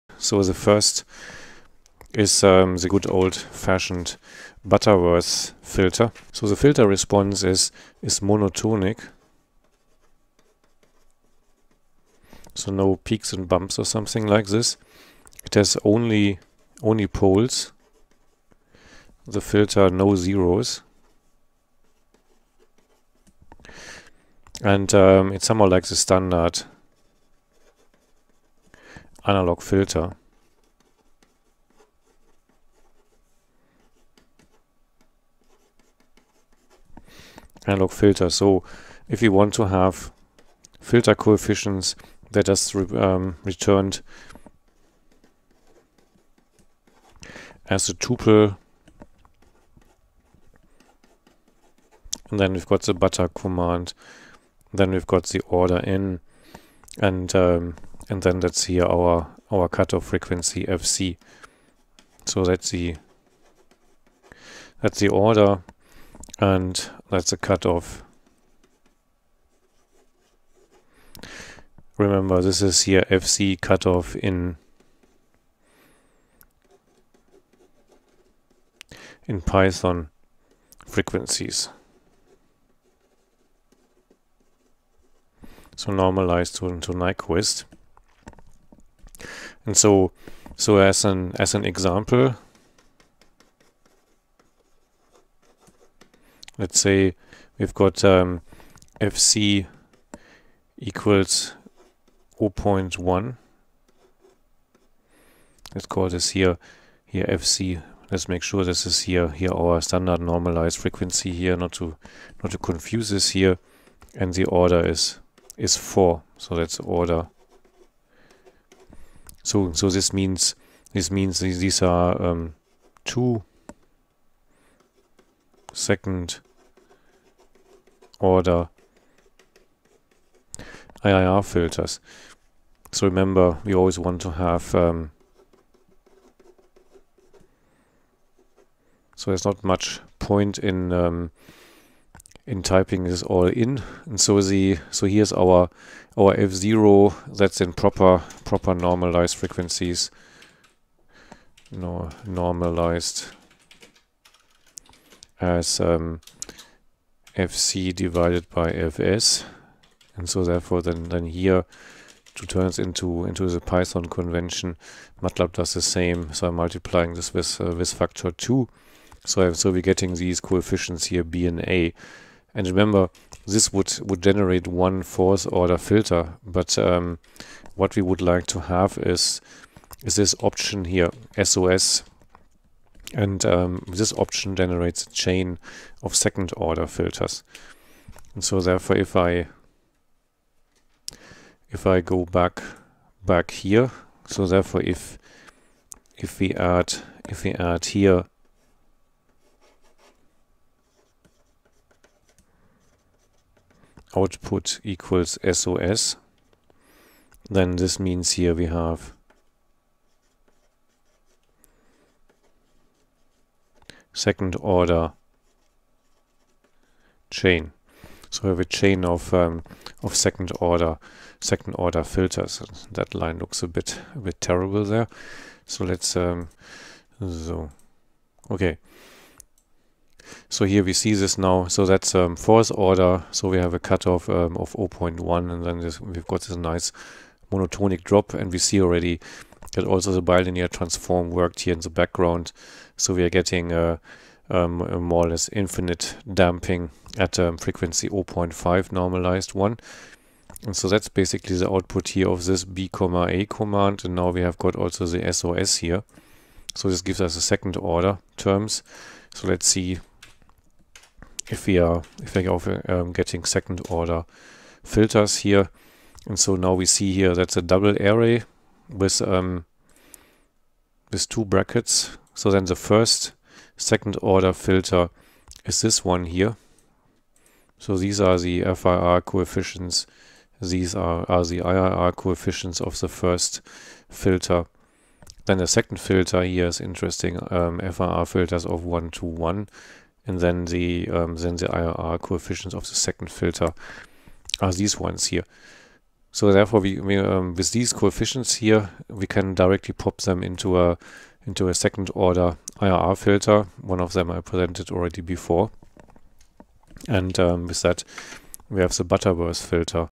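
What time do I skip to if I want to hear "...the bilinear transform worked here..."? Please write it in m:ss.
4:00.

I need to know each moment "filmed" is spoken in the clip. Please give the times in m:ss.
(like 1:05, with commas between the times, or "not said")
not said.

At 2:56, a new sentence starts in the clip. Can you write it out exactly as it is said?
But um, what we would like to have is, is this option here, SOS.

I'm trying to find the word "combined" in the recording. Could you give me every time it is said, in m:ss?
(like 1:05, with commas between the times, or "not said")
not said.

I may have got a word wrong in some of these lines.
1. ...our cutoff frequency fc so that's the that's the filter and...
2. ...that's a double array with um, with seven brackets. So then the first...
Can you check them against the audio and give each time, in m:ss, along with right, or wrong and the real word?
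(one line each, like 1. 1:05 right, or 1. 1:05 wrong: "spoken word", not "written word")
1. 0:59 wrong: "order", not "filter"
2. 4:27 wrong: "two", not "seven".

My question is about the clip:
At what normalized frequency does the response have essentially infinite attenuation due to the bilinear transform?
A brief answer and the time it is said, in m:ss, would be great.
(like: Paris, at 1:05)
0.5, at 4:08.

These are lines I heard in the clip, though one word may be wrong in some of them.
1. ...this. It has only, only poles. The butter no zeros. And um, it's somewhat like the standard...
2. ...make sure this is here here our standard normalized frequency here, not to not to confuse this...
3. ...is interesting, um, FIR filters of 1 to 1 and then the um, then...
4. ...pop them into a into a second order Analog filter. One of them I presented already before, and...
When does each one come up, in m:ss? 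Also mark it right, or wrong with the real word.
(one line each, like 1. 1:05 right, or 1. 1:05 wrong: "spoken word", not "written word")
1. 0:14 wrong: "filter", not "butter"
2. 1:48 right
3. 4:46 right
4. 4:59 wrong: "IIR", not "Analog".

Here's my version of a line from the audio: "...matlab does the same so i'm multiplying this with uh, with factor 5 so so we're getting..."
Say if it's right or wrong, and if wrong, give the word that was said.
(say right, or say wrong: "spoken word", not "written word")
wrong: "2", not "5".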